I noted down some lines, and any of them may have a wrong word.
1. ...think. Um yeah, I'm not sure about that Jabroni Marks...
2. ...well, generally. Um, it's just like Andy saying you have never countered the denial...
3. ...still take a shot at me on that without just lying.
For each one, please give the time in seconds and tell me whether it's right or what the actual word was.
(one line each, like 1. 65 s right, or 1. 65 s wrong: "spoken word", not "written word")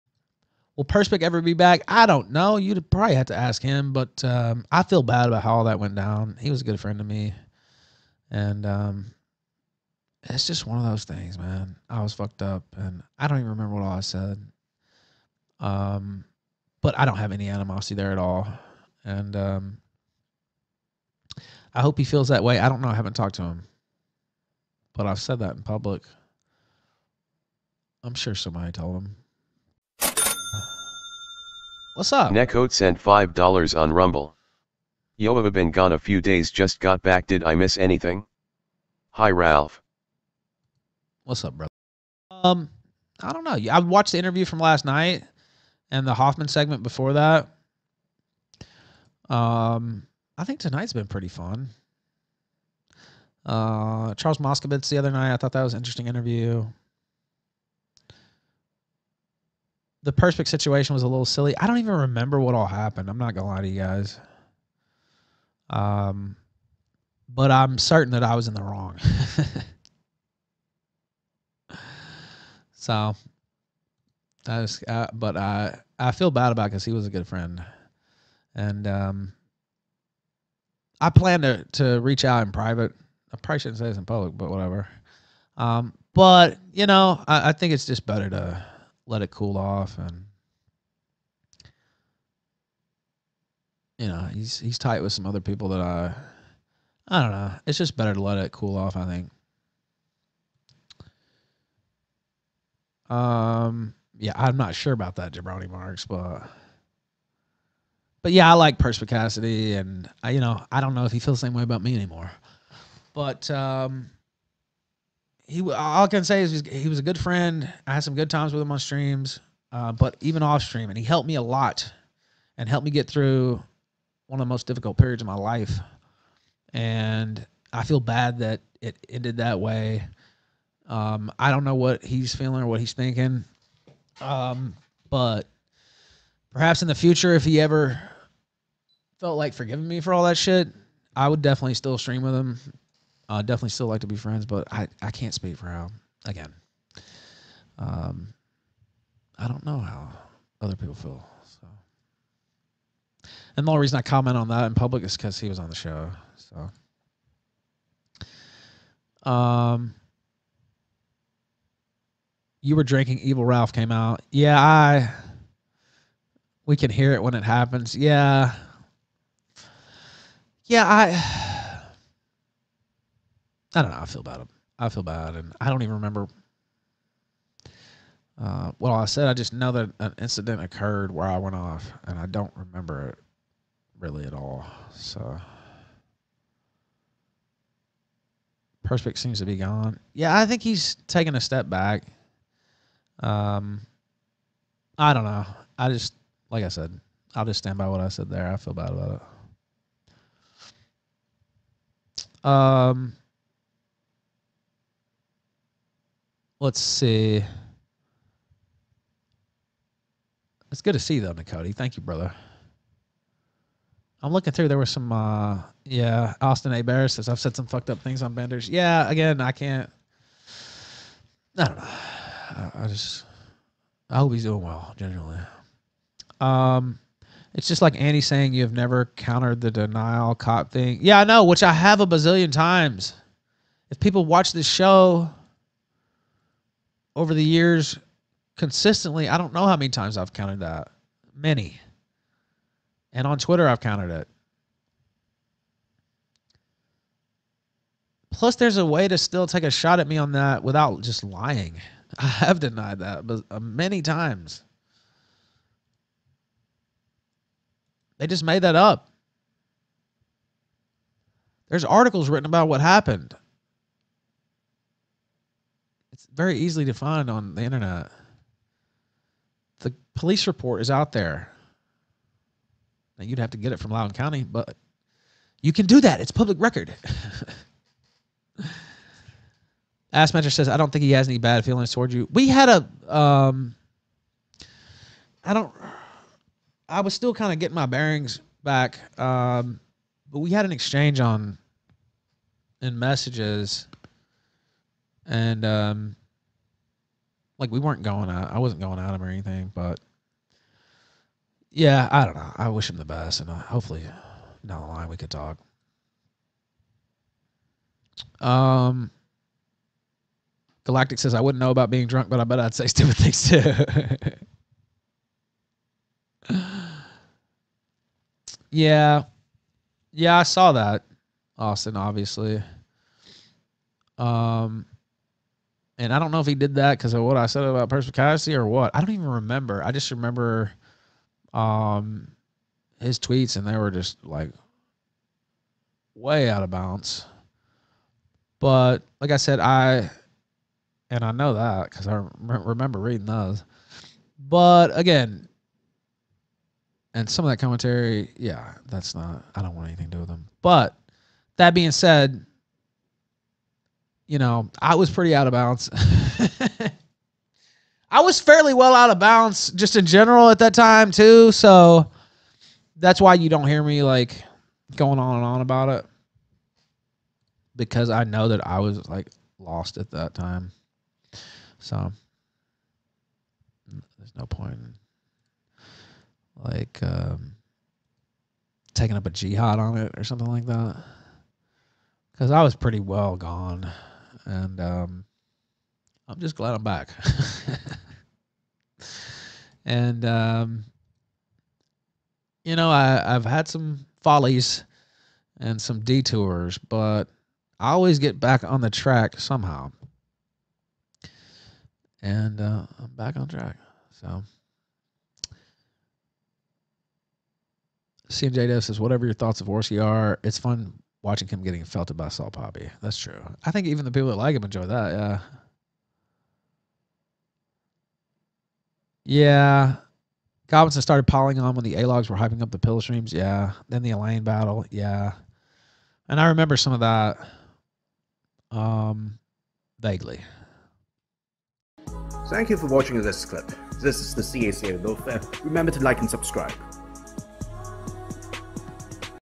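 1. 99 s right
2. 224 s right
3. 249 s right.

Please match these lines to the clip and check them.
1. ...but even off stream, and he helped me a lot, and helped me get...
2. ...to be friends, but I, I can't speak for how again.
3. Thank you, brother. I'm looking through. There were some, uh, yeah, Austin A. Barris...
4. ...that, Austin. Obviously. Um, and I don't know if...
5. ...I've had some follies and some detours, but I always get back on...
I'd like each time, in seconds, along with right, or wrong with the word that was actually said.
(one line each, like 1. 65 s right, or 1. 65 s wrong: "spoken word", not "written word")
1. 119 s right
2. 144 s right
3. 211 s right
4. 320 s right
5. 393 s right.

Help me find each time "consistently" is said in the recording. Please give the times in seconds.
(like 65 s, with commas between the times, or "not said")
238 s.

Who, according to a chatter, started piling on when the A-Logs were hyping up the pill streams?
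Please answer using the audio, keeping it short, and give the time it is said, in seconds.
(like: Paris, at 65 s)
Goblinson, at 420 s.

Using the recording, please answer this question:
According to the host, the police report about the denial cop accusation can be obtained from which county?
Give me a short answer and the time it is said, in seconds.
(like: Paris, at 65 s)
Loudoun County, at 273 s.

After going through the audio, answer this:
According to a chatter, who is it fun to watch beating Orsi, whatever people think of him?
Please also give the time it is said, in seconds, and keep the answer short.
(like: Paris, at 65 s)
Saul Poppy, at 412 s.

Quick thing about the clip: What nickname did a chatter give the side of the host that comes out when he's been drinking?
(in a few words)
Evil Ralph.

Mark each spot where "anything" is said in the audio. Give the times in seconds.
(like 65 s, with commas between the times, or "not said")
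37 s, 299 s, 349 s.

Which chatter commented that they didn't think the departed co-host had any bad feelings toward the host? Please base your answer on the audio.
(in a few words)
Assmaster.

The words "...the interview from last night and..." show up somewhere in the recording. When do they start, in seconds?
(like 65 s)
44 s.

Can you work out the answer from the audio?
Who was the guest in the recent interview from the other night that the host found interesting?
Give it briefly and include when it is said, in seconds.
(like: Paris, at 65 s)
Charles Moskowitz, at 54 s.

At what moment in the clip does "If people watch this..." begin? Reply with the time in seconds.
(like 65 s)
233 s.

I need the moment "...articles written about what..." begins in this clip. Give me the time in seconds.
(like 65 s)
261 s.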